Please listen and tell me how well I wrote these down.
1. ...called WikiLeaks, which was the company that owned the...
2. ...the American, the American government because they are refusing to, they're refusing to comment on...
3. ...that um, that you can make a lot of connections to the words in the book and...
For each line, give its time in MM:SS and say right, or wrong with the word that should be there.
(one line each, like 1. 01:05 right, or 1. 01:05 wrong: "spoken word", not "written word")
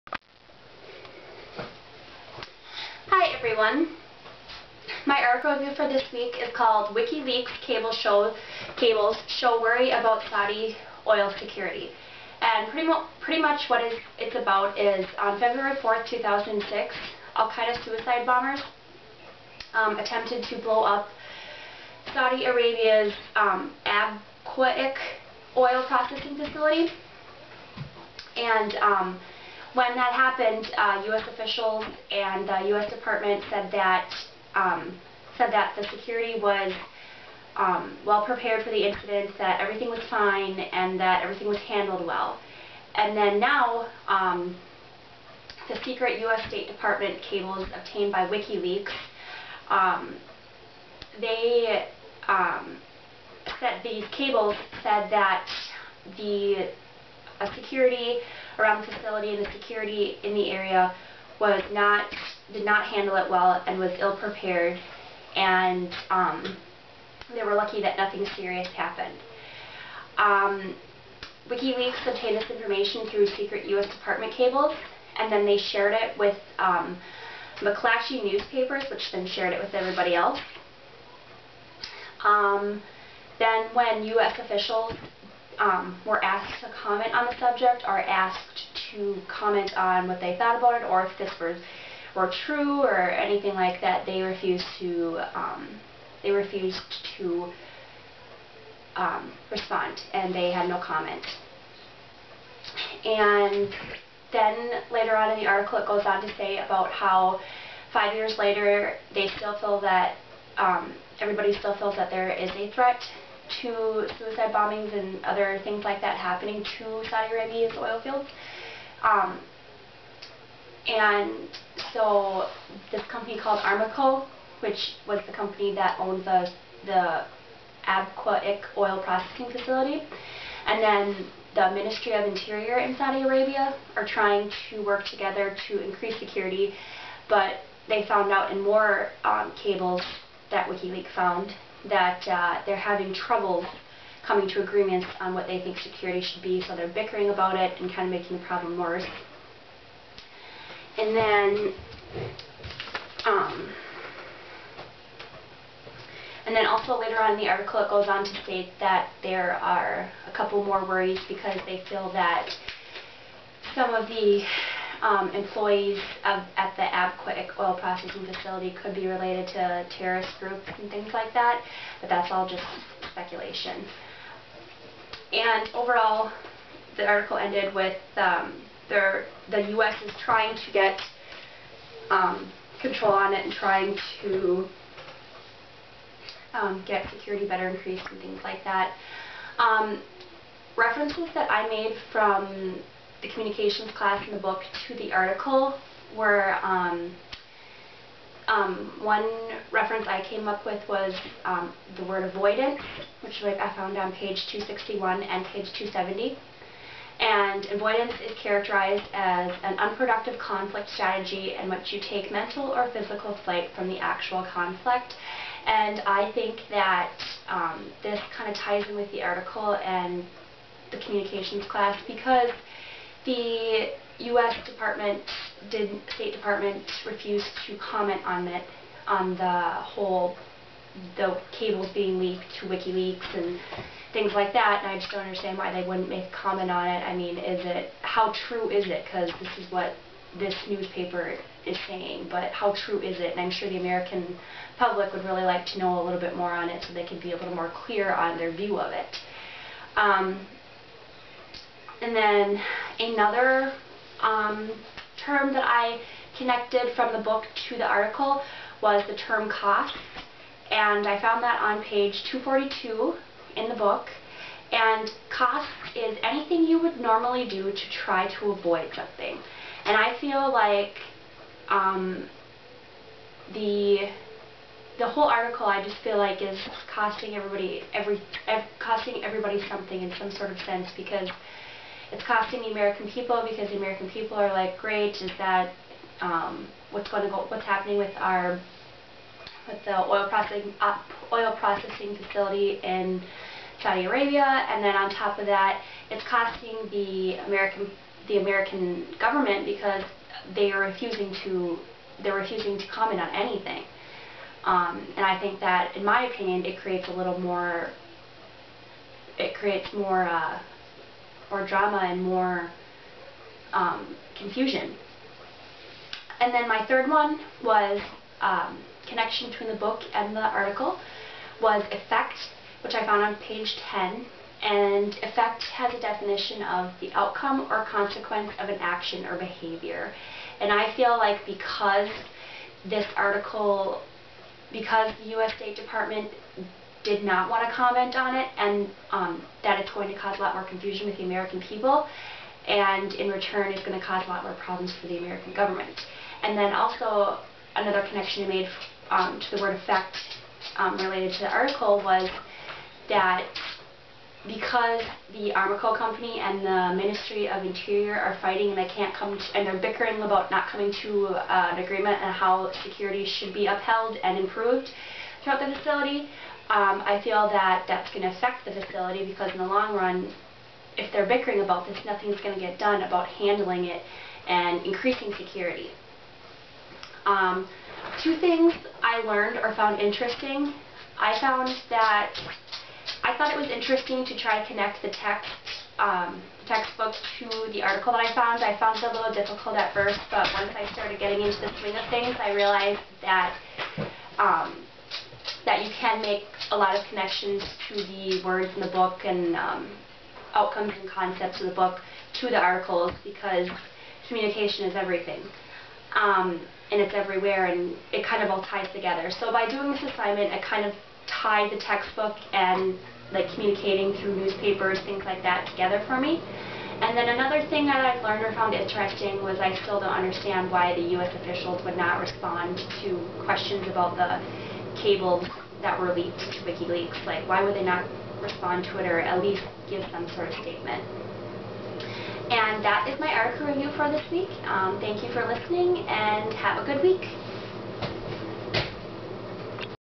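1. 02:03 wrong: "Aramco", not "WikiLeaks"
2. 04:56 right
3. 06:33 right.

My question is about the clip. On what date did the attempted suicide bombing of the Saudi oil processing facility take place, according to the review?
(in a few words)
February 4th, 2006.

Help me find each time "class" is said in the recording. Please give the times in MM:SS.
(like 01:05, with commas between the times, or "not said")
03:13, 03:41.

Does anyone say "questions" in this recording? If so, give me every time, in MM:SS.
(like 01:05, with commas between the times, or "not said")
07:03.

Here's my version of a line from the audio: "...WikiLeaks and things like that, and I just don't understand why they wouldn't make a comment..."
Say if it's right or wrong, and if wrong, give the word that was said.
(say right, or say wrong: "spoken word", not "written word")
right.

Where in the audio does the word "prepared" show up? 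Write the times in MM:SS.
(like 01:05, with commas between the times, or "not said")
00:38, 01:04.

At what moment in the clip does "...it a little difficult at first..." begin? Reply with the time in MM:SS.
06:28.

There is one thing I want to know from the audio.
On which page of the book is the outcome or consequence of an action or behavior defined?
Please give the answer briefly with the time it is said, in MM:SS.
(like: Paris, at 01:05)
10, at 05:23.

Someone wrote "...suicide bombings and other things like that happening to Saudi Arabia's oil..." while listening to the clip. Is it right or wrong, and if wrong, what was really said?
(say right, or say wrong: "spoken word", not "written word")
right.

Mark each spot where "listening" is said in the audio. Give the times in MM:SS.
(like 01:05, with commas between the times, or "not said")
07:15.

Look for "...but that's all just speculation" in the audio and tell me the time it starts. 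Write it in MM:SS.
02:52.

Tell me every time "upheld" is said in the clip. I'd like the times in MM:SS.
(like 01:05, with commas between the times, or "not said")
06:03.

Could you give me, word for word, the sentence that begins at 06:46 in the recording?
Um, and it's everywhere and it kind of all ties together.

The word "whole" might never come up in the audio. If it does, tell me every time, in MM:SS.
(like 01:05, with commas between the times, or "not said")
03:49, 04:35.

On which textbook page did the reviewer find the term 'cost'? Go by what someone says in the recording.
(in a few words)
242.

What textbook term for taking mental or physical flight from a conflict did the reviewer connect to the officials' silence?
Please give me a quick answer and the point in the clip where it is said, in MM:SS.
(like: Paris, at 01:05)
avoidant, at 03:22.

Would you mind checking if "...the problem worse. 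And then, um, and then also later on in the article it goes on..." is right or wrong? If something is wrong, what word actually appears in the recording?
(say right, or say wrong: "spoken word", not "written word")
right.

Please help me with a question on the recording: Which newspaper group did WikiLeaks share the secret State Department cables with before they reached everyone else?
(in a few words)
McClatchy.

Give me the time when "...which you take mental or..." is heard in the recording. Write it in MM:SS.
03:31.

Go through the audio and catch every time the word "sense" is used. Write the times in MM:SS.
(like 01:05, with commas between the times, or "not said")
04:40.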